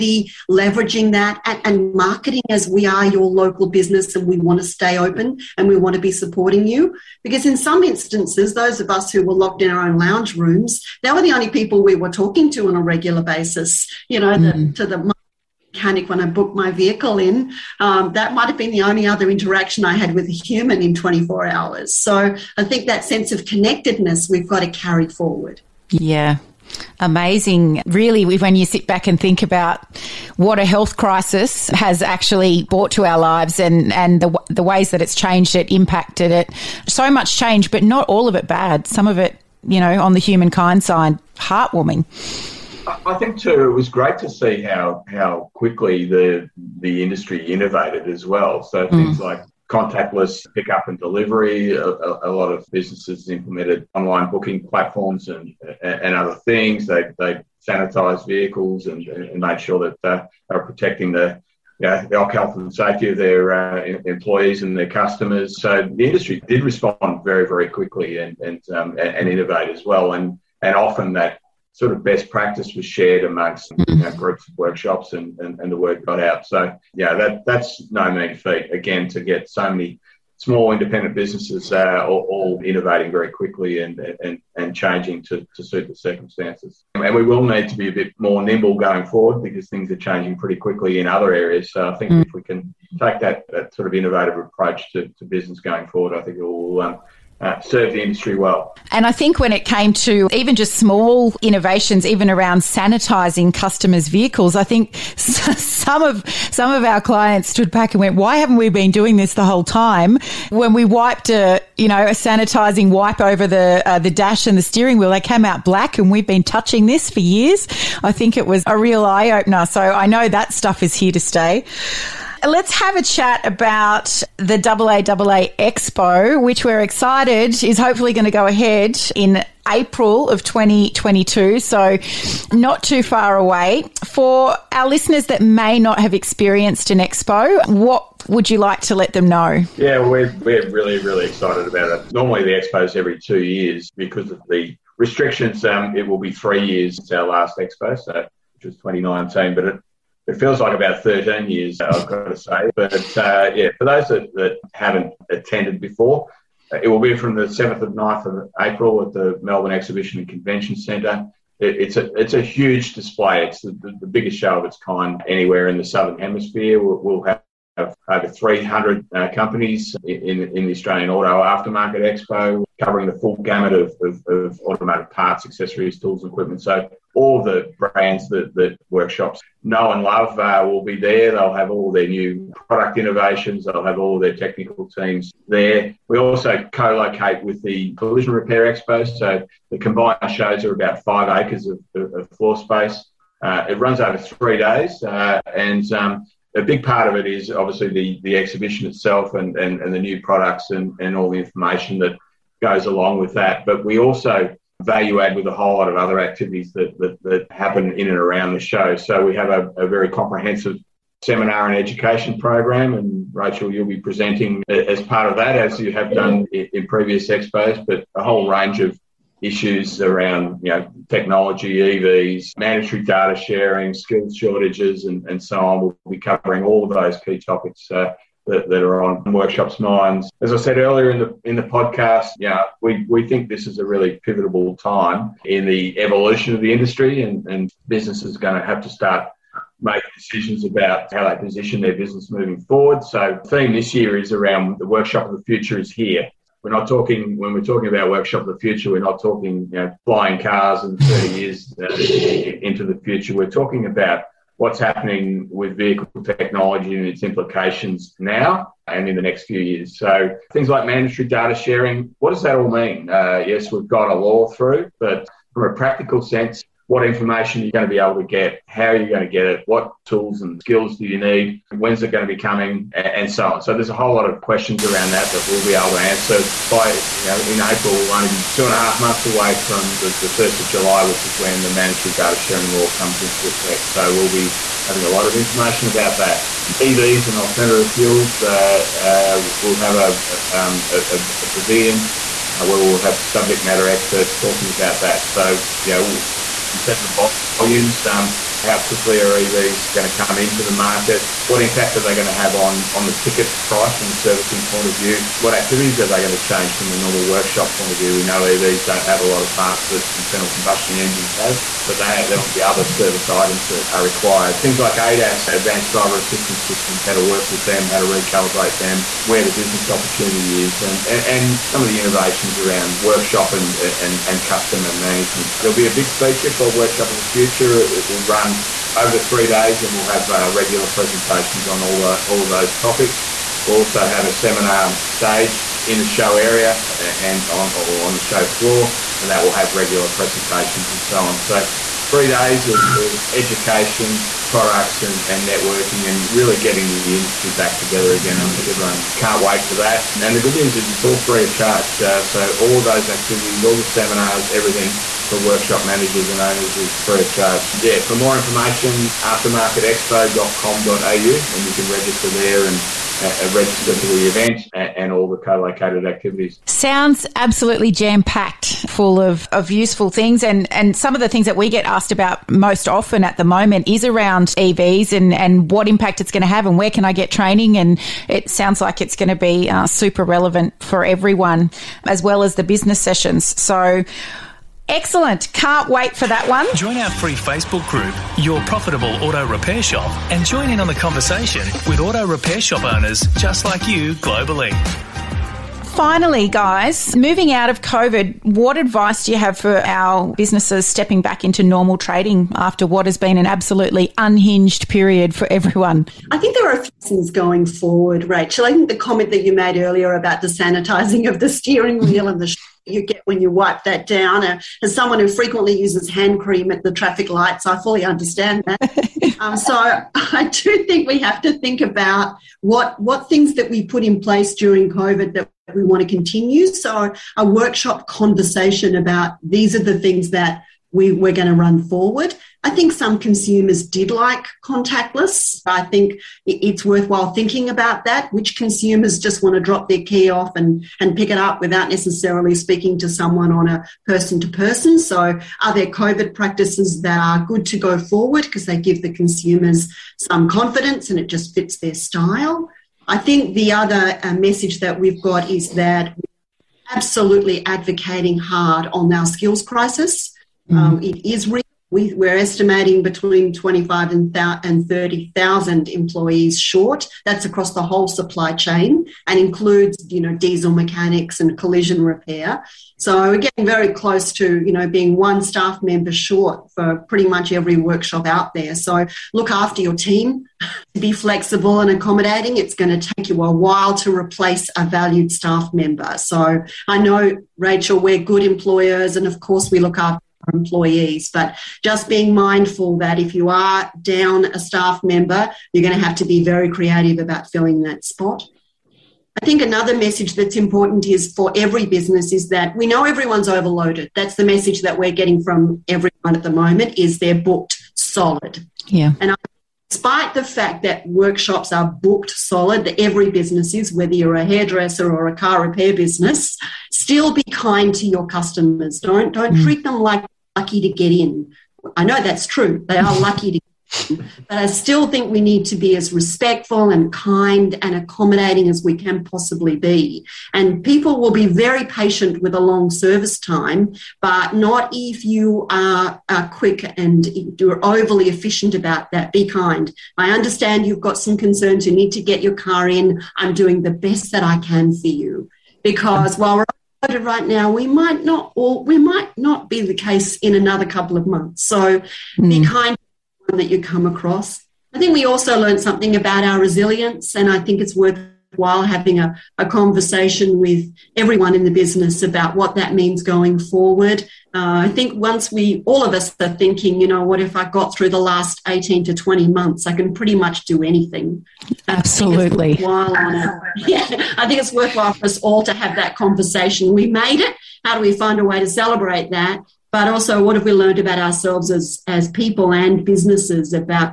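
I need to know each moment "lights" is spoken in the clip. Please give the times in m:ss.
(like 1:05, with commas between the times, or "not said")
6:57.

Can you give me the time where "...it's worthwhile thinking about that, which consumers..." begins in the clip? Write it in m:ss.
7:16.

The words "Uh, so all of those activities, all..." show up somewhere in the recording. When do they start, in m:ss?
5:51.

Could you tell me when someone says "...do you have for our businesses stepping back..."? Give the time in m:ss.
6:39.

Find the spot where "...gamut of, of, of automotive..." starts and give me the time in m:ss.
2:53.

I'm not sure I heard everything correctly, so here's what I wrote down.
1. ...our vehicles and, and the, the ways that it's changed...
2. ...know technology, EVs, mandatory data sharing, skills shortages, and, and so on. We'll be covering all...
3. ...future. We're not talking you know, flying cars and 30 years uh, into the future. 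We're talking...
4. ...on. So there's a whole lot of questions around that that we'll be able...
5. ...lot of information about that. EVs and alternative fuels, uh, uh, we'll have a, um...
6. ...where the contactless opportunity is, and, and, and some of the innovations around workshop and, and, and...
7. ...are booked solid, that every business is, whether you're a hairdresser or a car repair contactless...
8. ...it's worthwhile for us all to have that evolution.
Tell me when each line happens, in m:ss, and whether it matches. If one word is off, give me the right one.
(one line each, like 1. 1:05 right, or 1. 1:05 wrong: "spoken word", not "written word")
1. 0:33 wrong: "lives", not "vehicles"
2. 3:40 right
3. 4:08 right
4. 4:33 right
5. 4:45 right
6. 5:19 wrong: "business", not "contactless"
7. 8:31 wrong: "business", not "contactless"
8. 9:34 wrong: "conversation", not "evolution".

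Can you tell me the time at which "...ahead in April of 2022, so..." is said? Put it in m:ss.
2:08.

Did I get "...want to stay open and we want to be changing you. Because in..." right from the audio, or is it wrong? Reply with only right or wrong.
wrong.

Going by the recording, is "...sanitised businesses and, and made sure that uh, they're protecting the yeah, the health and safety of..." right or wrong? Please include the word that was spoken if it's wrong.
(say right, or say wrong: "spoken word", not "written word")
wrong: "vehicles", not "businesses".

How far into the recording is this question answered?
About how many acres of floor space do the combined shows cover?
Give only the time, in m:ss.
3:11.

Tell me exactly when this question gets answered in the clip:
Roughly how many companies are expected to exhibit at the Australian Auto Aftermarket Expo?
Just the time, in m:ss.
2:48.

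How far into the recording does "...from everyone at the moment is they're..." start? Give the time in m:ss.
8:25.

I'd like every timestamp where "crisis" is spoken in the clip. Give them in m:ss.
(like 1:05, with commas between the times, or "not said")
0:30, 7:39.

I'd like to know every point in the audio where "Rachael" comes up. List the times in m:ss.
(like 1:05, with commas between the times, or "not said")
3:33, 6:48, 8:07.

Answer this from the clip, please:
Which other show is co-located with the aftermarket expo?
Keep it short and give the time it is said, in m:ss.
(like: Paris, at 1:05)
Collision Repair Expo, at 3:07.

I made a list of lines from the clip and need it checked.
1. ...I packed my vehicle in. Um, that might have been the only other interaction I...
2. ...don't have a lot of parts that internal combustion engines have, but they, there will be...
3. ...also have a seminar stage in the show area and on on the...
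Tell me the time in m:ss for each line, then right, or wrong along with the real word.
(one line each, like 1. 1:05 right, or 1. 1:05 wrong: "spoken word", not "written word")
1. 0:16 wrong: "booked", not "packed"
2. 5:08 right
3. 5:33 right.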